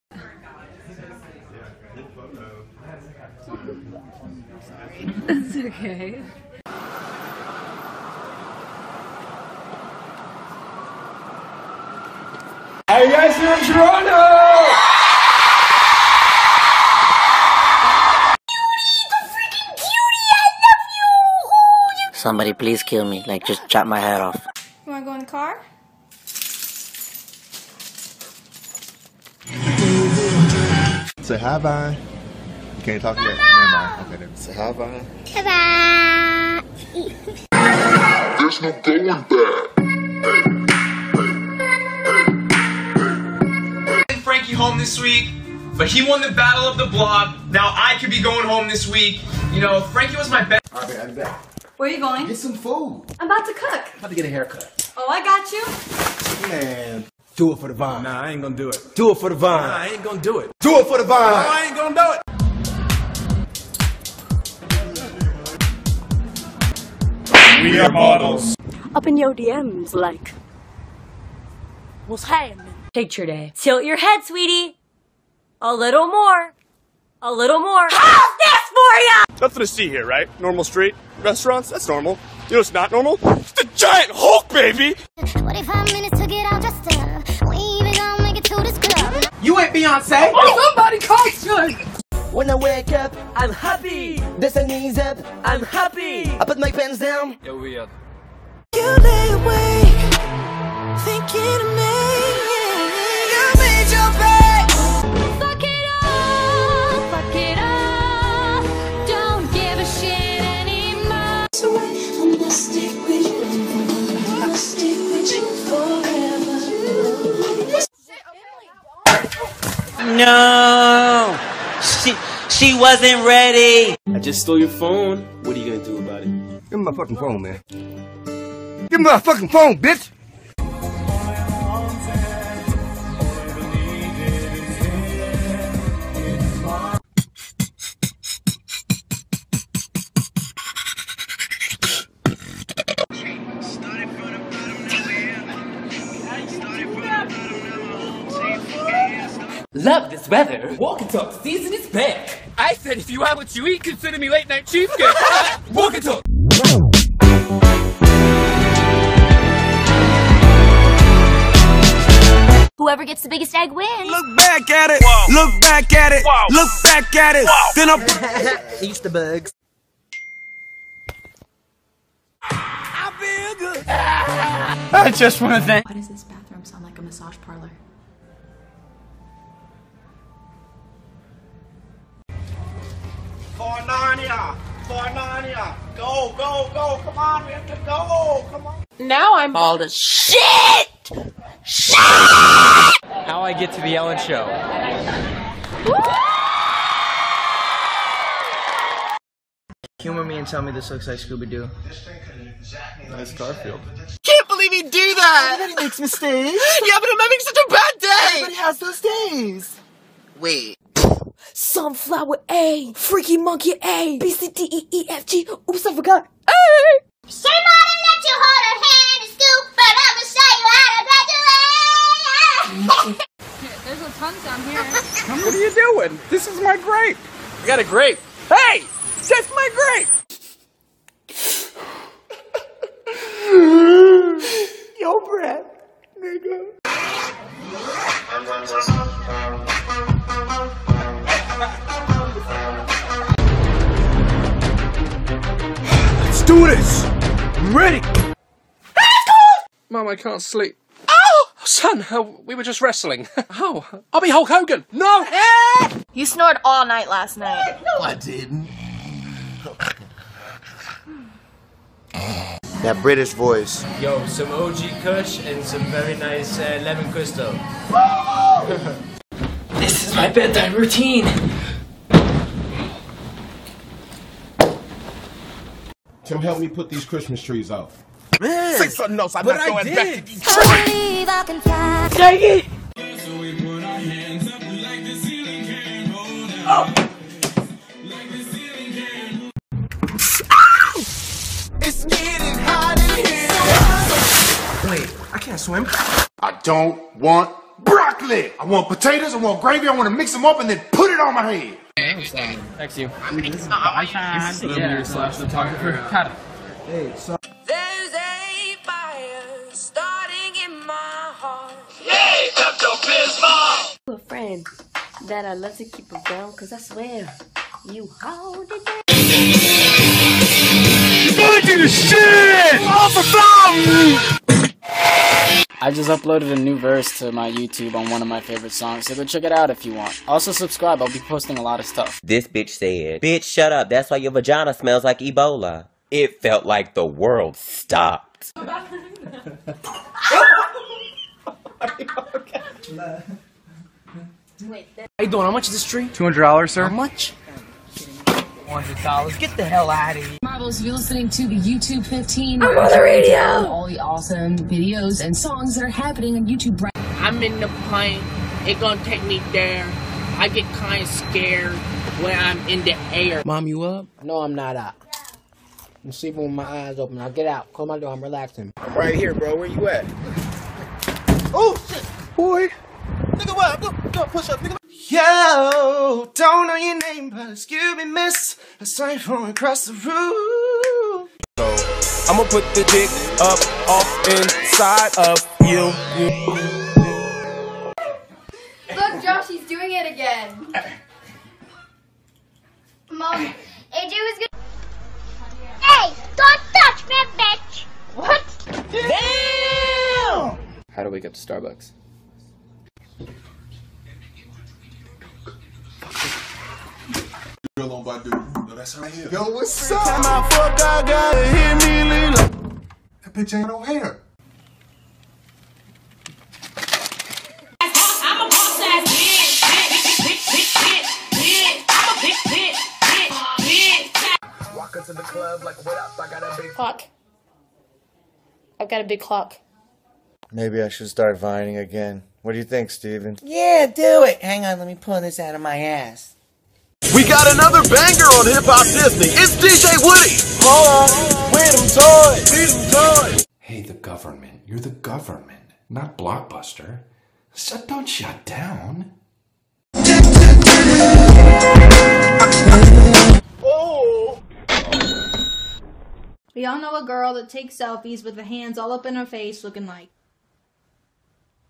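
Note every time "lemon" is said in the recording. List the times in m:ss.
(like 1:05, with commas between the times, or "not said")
4:26.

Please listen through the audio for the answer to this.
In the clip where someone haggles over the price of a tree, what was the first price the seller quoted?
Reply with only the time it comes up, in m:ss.
5:46.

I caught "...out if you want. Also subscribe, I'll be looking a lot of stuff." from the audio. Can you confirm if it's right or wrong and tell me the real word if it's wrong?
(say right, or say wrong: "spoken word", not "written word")
wrong: "posting", not "looking".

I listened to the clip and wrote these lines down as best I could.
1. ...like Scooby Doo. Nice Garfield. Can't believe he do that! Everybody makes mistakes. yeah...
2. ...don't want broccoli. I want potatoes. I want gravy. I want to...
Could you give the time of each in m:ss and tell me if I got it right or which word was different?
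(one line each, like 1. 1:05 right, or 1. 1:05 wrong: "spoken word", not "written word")
1. 3:21 right
2. 4:56 right.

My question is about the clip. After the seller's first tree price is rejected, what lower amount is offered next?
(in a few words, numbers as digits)
$100.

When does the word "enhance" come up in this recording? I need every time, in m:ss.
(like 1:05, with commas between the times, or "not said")
not said.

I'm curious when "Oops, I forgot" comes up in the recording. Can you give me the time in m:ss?
3:35.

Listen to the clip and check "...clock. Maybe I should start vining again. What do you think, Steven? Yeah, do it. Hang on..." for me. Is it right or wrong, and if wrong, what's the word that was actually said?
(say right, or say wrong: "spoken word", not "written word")
right.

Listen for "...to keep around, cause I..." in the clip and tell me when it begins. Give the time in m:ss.
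5:15.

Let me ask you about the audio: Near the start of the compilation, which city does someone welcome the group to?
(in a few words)
Toronto.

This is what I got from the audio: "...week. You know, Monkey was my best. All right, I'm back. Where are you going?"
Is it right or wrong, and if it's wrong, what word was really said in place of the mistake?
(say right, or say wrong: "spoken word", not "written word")
wrong: "Frankie", not "Monkey".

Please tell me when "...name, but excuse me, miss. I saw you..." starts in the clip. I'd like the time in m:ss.
6:16.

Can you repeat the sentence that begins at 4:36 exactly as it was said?
Tim, help me put these Christmas trees out.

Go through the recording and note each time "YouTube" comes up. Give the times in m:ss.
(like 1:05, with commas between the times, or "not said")
5:27, 5:51, 5:56.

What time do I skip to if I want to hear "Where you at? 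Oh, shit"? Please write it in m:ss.
6:09.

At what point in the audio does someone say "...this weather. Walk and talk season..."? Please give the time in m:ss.
2:30.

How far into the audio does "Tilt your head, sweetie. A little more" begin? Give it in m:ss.
1:13.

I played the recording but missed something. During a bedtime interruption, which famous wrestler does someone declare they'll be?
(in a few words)
Hulk Hogan.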